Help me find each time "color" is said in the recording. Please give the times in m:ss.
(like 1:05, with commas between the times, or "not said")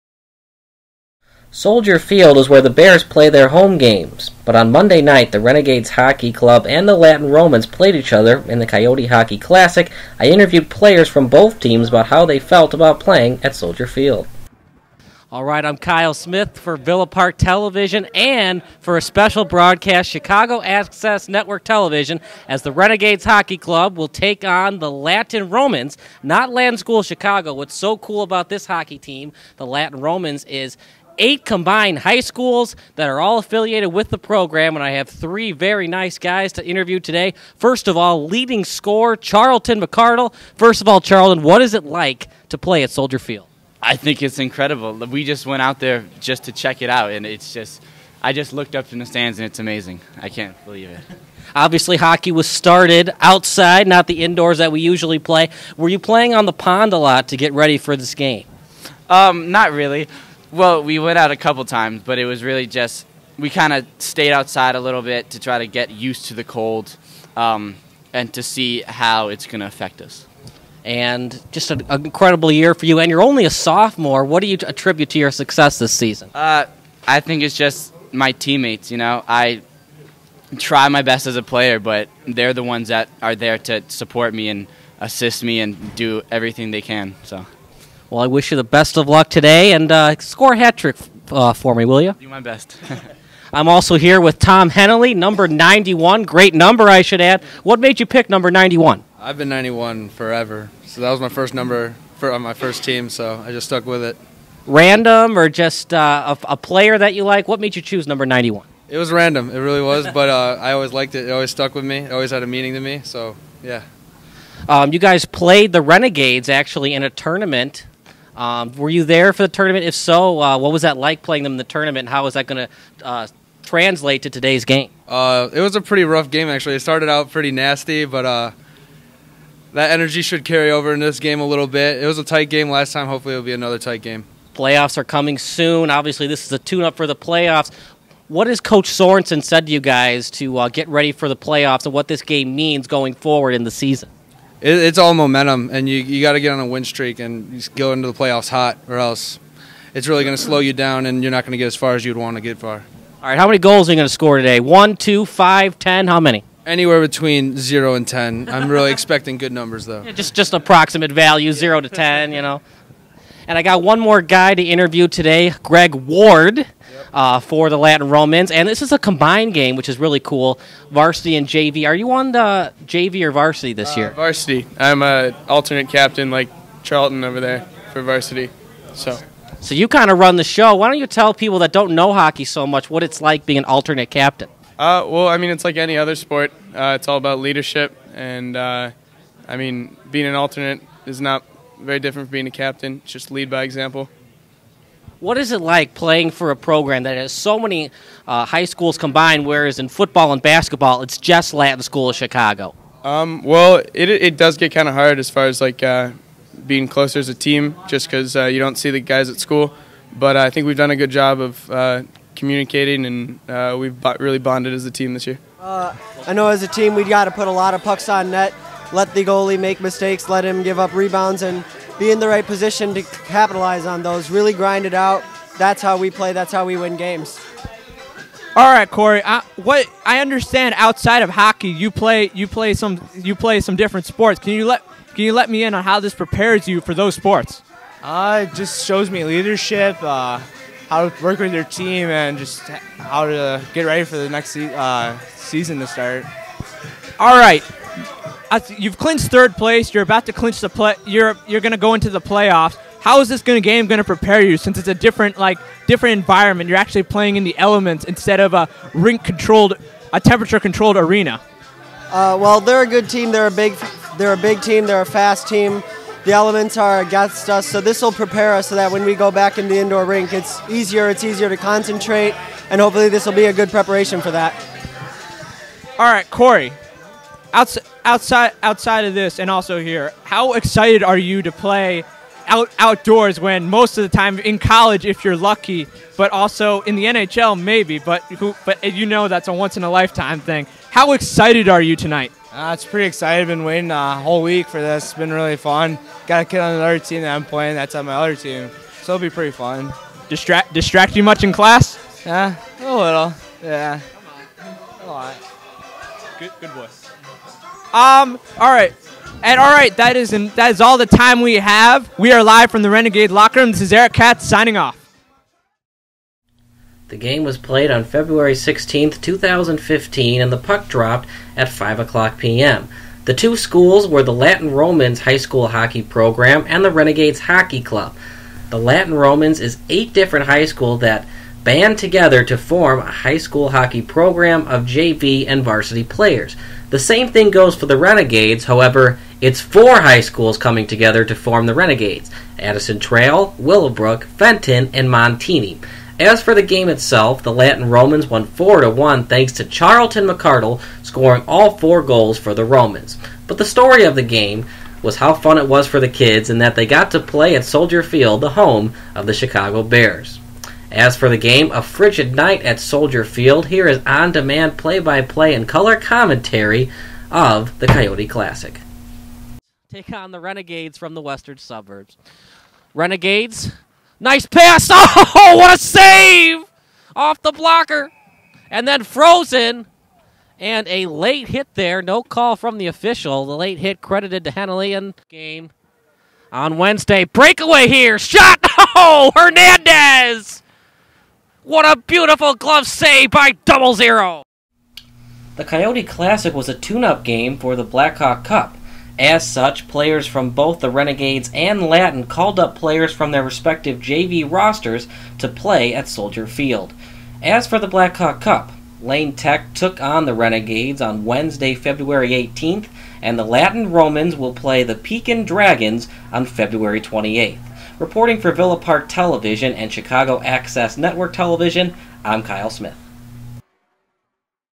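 6:05.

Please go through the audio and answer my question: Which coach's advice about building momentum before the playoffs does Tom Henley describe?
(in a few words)
Coach Sorensen.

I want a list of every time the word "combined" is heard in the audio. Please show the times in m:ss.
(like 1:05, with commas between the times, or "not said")
0:31, 2:48, 3:18.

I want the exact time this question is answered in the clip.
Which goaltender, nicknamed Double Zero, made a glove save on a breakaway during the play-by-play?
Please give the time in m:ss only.
6:29.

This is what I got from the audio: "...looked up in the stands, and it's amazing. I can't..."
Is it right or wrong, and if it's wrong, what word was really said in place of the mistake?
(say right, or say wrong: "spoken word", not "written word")
right.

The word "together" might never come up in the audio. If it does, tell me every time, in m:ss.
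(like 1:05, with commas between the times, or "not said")
5:31, 5:40.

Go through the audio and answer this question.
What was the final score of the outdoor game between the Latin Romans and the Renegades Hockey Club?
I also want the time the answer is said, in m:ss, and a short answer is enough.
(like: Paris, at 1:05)
4 to 1, at 5:48.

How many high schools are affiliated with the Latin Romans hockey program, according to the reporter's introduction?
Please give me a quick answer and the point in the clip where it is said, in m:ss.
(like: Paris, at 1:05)
8, at 0:31.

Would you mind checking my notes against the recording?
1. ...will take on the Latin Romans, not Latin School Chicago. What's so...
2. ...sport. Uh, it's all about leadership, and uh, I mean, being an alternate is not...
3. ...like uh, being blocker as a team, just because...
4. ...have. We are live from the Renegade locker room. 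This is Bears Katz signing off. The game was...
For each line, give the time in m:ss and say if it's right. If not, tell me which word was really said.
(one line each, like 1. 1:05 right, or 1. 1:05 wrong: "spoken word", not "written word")
1. 0:23 right
2. 3:06 right
3. 3:25 wrong: "closer", not "blocker"
4. 5:11 wrong: "Eric", not "Bears".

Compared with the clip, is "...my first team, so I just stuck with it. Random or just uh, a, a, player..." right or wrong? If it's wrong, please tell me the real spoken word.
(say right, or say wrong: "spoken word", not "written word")
right.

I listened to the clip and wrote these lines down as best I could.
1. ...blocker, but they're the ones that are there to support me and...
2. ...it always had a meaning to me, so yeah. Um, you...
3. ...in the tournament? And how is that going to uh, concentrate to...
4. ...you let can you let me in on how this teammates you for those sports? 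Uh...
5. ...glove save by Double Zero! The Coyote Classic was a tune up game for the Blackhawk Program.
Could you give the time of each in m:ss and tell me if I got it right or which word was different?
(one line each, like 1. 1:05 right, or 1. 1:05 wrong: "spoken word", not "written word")
1. 1:21 wrong: "player", not "blocker"
2. 1:51 right
3. 2:01 wrong: "translate", not "concentrate"
4. 3:54 wrong: "prepares", not "teammates"
5. 6:32 wrong: "Cup", not "Program".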